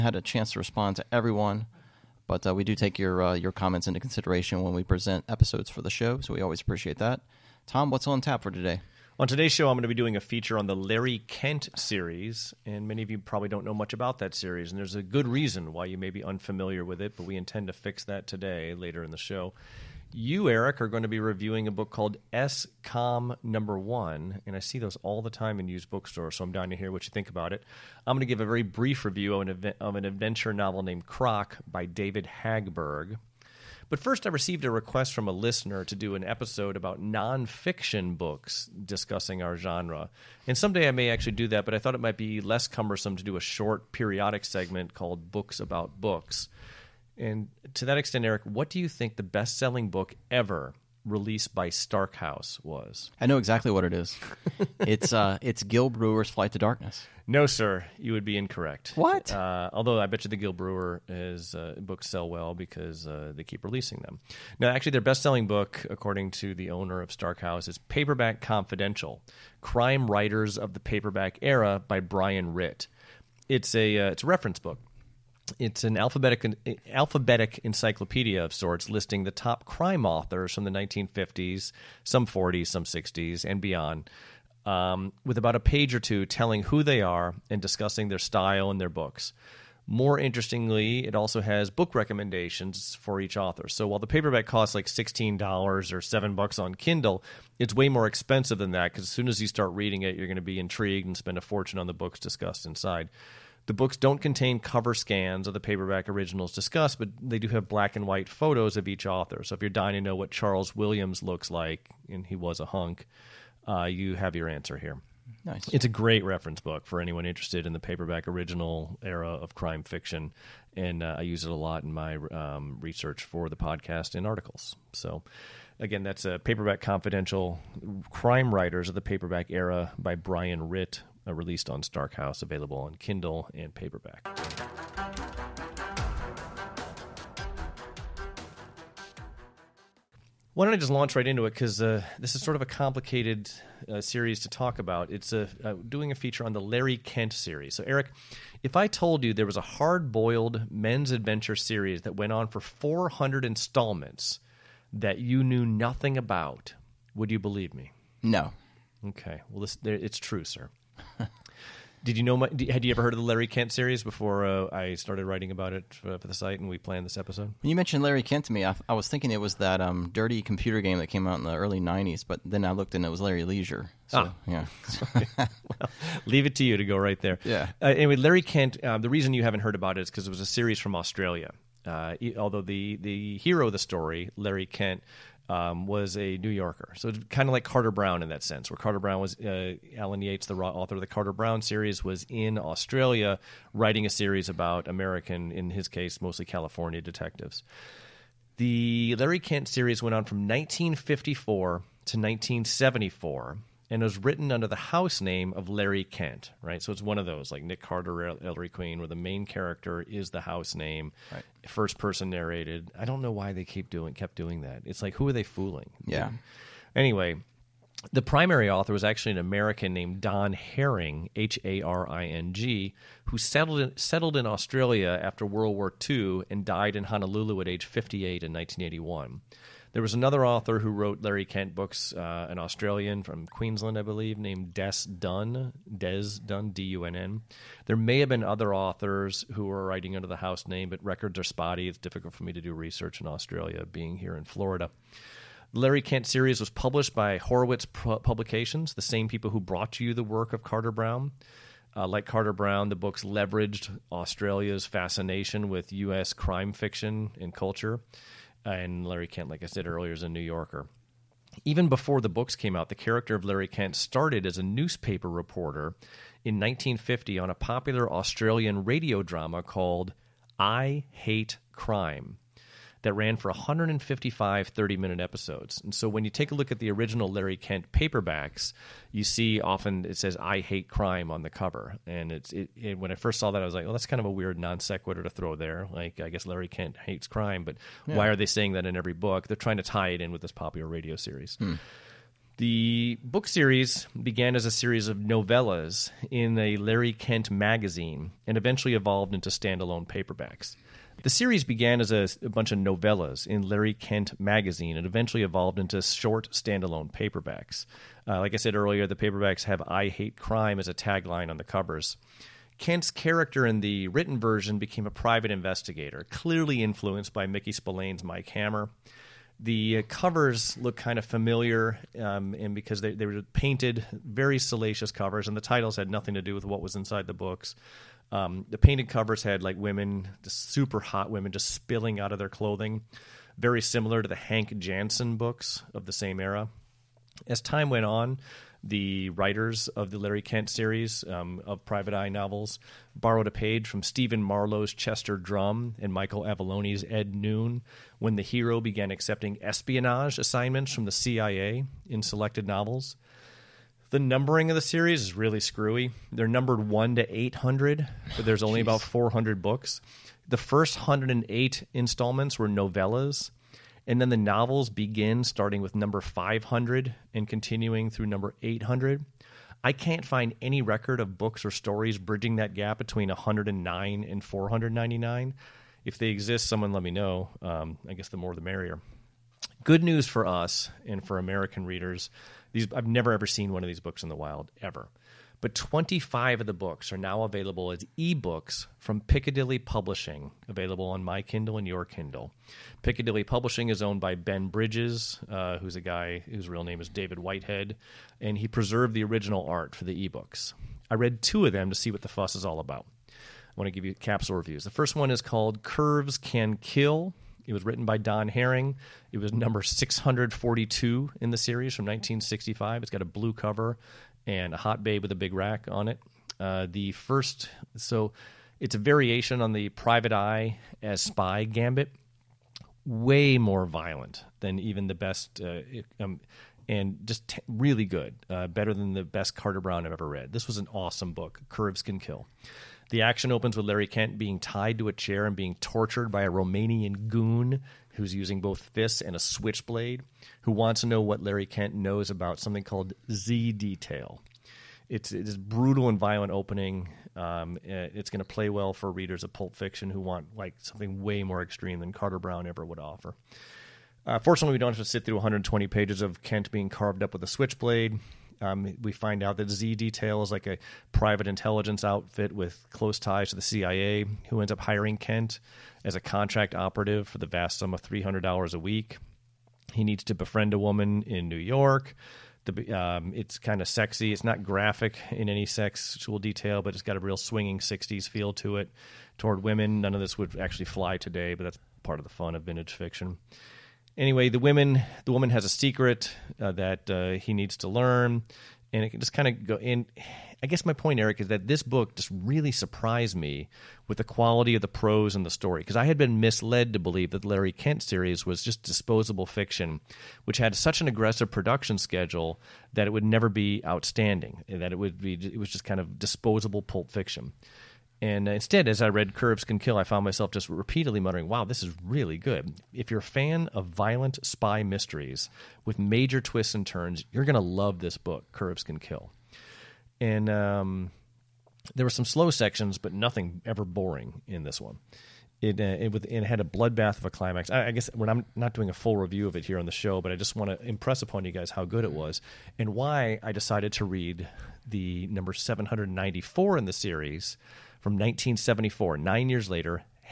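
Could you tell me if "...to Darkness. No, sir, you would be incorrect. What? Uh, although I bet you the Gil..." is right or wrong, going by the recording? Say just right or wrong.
right.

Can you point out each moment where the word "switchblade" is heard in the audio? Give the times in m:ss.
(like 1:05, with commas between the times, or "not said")
7:19, 7:37.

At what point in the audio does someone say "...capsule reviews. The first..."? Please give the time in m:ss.
6:44.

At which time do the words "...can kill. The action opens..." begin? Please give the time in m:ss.
7:12.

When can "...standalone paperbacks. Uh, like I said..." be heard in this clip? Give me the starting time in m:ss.
5:06.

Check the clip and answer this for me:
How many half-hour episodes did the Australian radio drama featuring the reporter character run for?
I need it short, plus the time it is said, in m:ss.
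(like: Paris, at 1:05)
155, at 4:33.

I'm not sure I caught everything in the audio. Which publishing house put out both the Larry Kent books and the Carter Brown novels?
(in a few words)
Horowitz Publications.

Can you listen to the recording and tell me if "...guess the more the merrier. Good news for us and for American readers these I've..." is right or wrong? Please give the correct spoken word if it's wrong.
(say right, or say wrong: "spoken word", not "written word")
right.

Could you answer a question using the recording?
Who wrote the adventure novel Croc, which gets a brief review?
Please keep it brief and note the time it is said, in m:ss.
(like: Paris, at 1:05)
David Hagberg, at 0:31.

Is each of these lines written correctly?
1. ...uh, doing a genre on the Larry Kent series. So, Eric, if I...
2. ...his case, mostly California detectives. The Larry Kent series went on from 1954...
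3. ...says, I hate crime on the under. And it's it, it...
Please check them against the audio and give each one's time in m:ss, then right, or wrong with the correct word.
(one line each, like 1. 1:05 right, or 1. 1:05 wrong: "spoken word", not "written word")
1. 2:25 wrong: "feature", not "genre"
2. 3:15 right
3. 4:40 wrong: "cover", not "under".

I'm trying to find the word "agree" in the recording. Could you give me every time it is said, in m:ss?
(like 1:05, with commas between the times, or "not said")
not said.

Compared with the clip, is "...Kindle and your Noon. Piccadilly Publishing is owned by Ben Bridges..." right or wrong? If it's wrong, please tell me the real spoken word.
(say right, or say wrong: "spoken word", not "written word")
wrong: "Kindle", not "Noon".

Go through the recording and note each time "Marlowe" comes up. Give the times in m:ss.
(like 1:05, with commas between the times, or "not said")
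5:44.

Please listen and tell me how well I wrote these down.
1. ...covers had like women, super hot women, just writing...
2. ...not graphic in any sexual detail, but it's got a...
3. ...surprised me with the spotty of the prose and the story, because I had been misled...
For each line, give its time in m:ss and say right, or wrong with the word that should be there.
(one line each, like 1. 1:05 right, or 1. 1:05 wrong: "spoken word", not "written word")
1. 5:29 wrong: "spilling", not "writing"
2. 7:54 right
3. 8:12 wrong: "quality", not "spotty".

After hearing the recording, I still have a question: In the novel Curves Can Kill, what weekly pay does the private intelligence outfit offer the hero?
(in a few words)
$300.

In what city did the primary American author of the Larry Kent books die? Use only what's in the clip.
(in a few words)
Honolulu.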